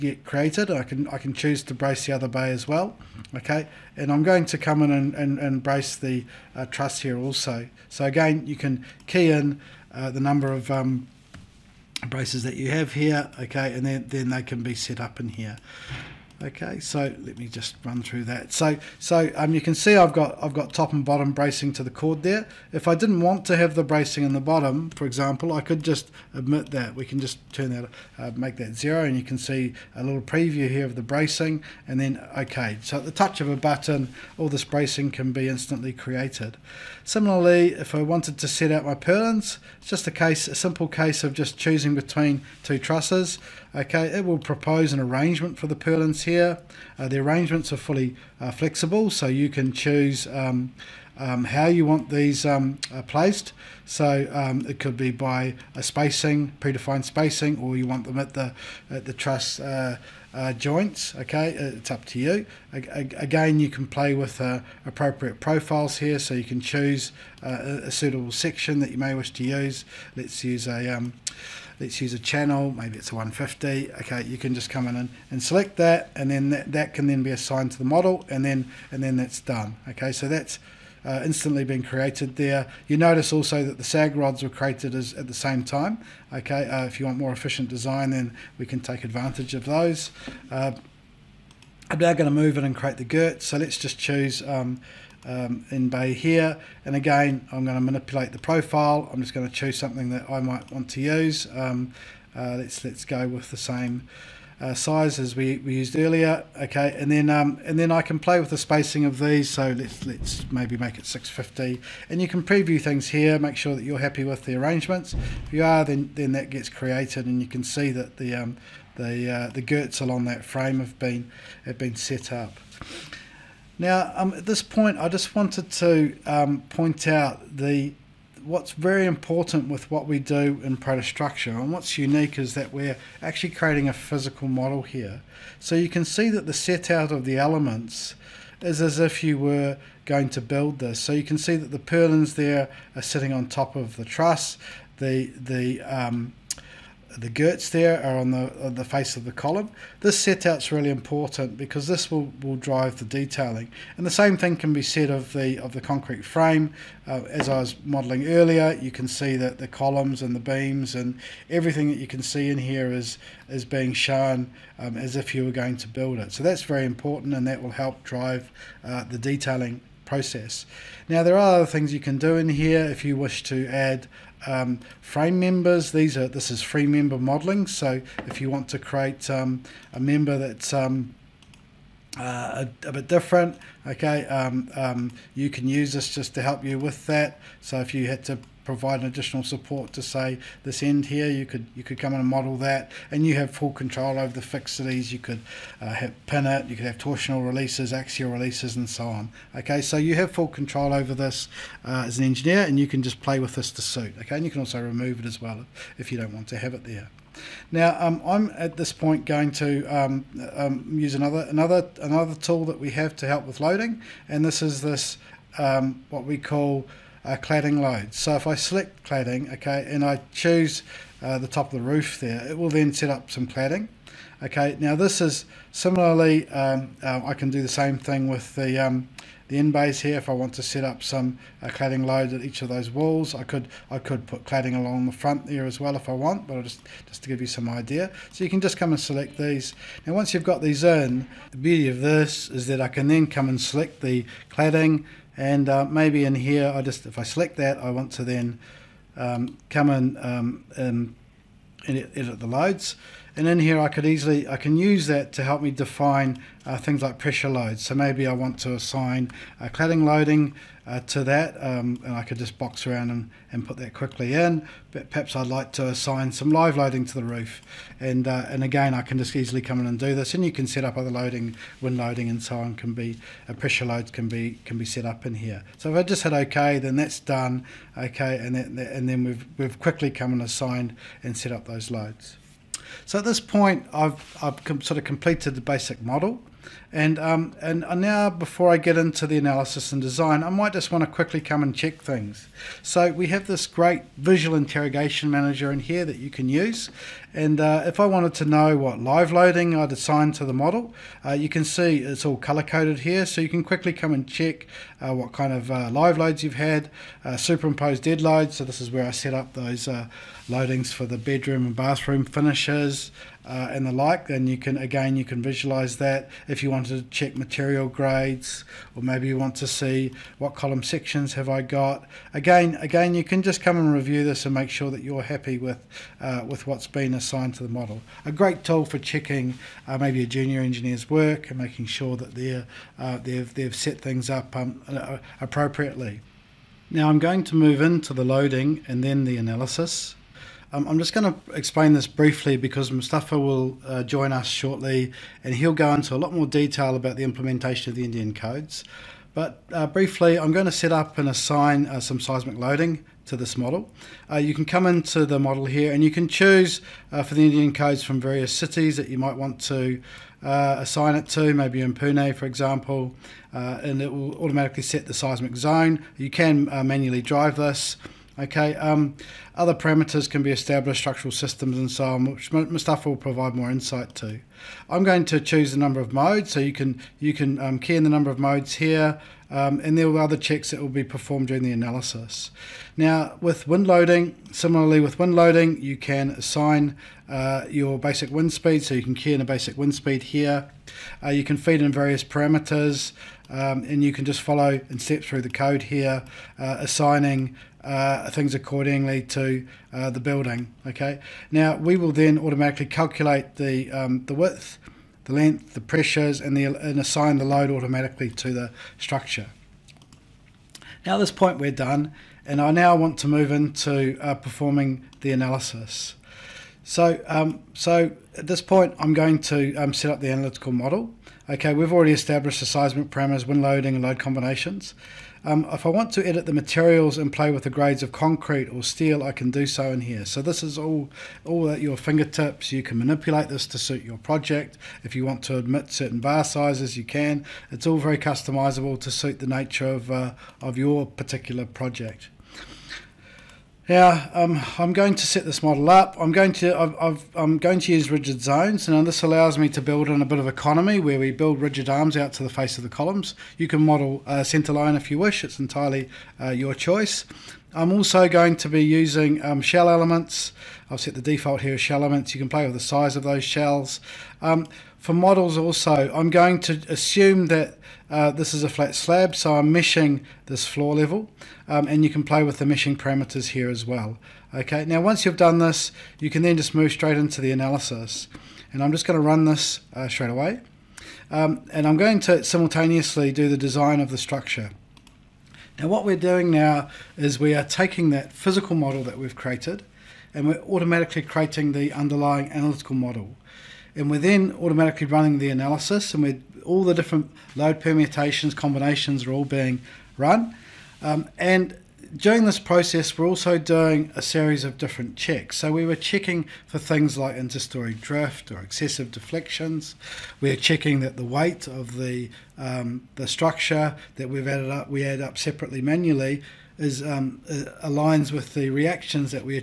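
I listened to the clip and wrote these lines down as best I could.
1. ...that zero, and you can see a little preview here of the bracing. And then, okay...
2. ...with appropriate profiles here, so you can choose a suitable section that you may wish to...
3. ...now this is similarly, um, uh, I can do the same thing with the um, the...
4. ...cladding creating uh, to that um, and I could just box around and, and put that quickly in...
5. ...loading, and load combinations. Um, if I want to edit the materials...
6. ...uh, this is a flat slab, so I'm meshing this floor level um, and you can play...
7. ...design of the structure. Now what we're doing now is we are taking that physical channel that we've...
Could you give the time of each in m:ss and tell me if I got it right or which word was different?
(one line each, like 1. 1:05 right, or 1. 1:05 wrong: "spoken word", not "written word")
1. 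0:28 right
2. 1:04 right
3. 3:44 right
4. 4:19 wrong: "loading", not "creating"
5. 7:03 right
6. 7:48 right
7. 8:03 wrong: "model", not "channel".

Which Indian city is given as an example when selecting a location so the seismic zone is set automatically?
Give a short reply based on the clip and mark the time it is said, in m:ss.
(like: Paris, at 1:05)
Pune, at 6:01.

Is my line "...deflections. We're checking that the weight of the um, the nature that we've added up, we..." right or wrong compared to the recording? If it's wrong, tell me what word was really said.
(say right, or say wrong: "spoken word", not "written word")
wrong: "structure", not "nature".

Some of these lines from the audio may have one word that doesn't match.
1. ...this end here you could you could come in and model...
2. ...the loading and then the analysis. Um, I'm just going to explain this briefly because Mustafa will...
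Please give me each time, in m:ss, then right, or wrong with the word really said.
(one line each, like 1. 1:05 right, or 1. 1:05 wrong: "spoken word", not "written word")
1. 3:10 right
2. 5:38 right.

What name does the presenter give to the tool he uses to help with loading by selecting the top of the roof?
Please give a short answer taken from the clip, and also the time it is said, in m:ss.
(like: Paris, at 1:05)
Cladding load, at 3:37.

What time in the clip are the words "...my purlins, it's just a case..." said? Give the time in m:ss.
0:38.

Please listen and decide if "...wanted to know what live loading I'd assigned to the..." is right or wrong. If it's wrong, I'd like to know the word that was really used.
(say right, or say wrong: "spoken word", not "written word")
right.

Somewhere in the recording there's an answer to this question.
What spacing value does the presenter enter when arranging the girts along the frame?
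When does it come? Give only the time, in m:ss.
1:50.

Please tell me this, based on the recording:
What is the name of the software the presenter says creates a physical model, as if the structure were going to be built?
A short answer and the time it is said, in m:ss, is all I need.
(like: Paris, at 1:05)
ProtaStructure, at 2:10.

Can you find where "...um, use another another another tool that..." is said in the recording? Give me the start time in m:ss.
3:30.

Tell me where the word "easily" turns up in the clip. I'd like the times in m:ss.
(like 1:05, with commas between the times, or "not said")
4:14, 4:29.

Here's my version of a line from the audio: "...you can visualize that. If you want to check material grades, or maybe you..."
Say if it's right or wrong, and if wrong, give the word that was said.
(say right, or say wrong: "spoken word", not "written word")
right.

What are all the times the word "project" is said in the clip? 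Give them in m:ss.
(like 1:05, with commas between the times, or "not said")
7:14, 7:21.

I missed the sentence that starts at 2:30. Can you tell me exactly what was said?
This set is really important because this will, will drive the detailing.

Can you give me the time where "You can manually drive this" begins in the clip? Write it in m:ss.
6:06.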